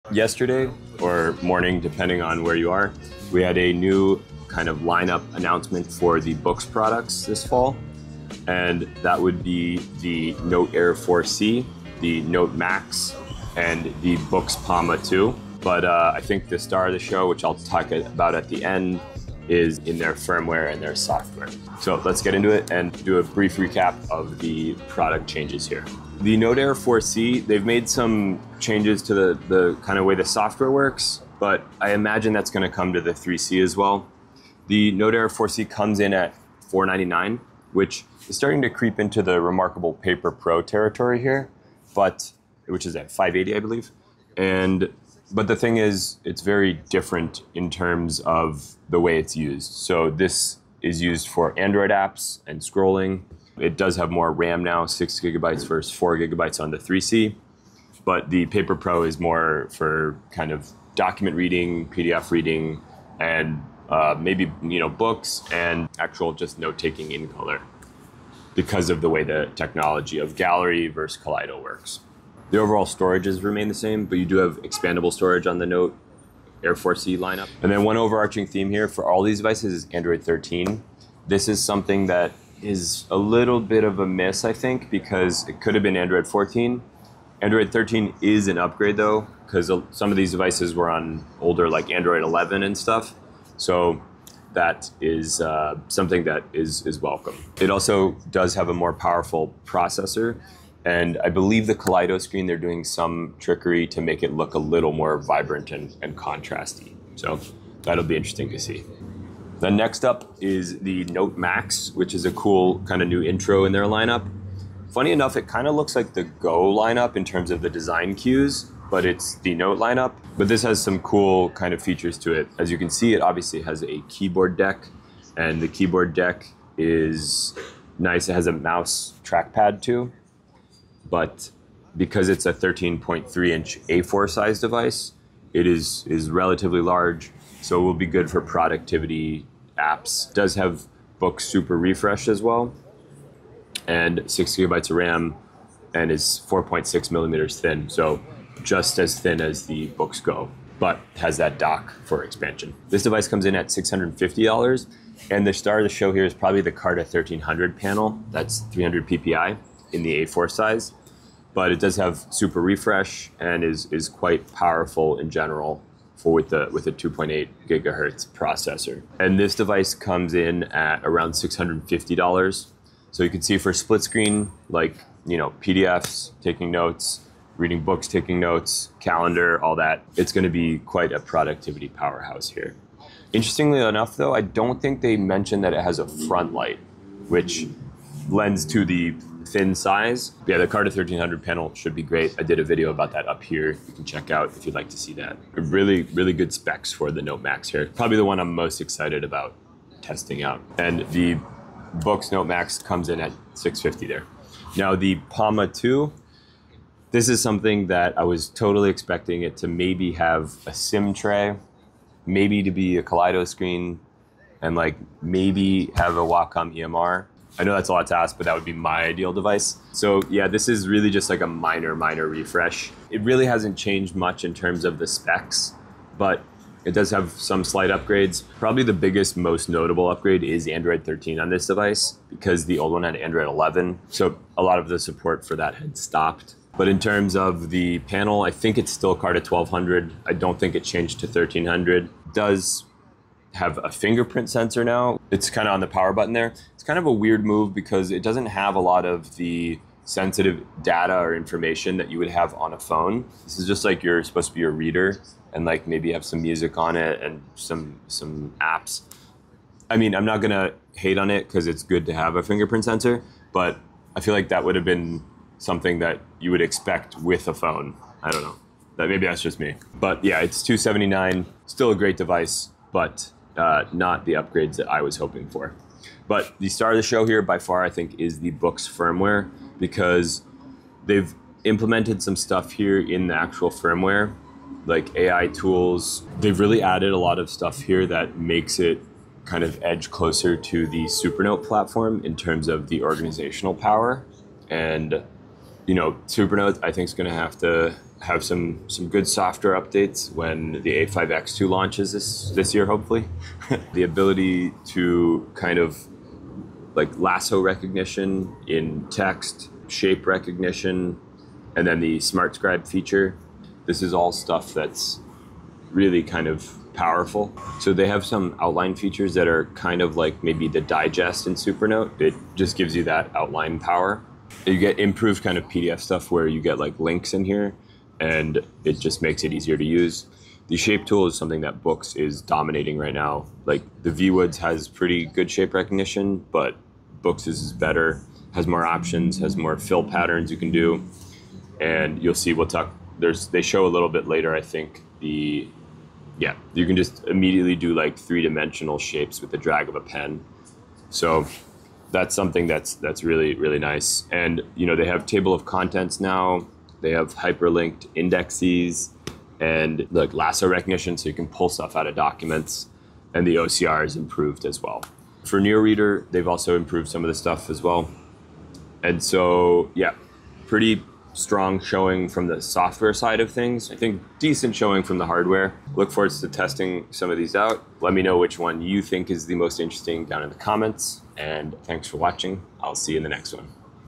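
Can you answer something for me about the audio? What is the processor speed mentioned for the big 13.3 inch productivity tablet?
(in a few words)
2.8 gigahertz.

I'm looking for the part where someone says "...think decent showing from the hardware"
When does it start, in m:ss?
6:13.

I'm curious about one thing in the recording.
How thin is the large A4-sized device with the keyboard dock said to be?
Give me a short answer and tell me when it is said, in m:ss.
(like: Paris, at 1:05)
4.6 millimeters, at 2:26.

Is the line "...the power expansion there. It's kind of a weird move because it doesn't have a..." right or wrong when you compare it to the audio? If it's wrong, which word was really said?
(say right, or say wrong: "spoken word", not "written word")
wrong: "button", not "expansion".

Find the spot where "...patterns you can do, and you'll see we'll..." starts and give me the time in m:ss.
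5:40.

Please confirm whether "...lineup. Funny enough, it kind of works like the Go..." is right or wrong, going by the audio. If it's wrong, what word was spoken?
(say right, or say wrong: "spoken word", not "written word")
wrong: "looks", not "works".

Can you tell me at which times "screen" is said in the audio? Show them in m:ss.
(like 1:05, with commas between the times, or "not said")
1:42, 2:54, 3:33.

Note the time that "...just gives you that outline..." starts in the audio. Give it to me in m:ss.
5:22.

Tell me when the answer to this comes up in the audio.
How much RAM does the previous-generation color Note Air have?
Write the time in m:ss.
0:55.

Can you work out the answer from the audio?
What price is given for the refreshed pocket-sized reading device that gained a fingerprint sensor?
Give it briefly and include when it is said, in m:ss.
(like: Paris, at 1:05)
$279, at 4:30.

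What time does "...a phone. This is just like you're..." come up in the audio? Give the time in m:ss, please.
4:12.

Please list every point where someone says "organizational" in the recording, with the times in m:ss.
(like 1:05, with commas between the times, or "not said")
4:53.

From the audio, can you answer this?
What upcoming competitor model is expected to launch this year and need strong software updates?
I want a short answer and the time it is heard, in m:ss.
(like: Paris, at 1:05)
A5X2, at 5:01.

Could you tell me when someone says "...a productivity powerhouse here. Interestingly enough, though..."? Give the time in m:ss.
3:01.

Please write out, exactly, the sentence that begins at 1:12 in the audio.
The overall storages remain the same, but you do have expandable storage on the Note Air 4C lineup.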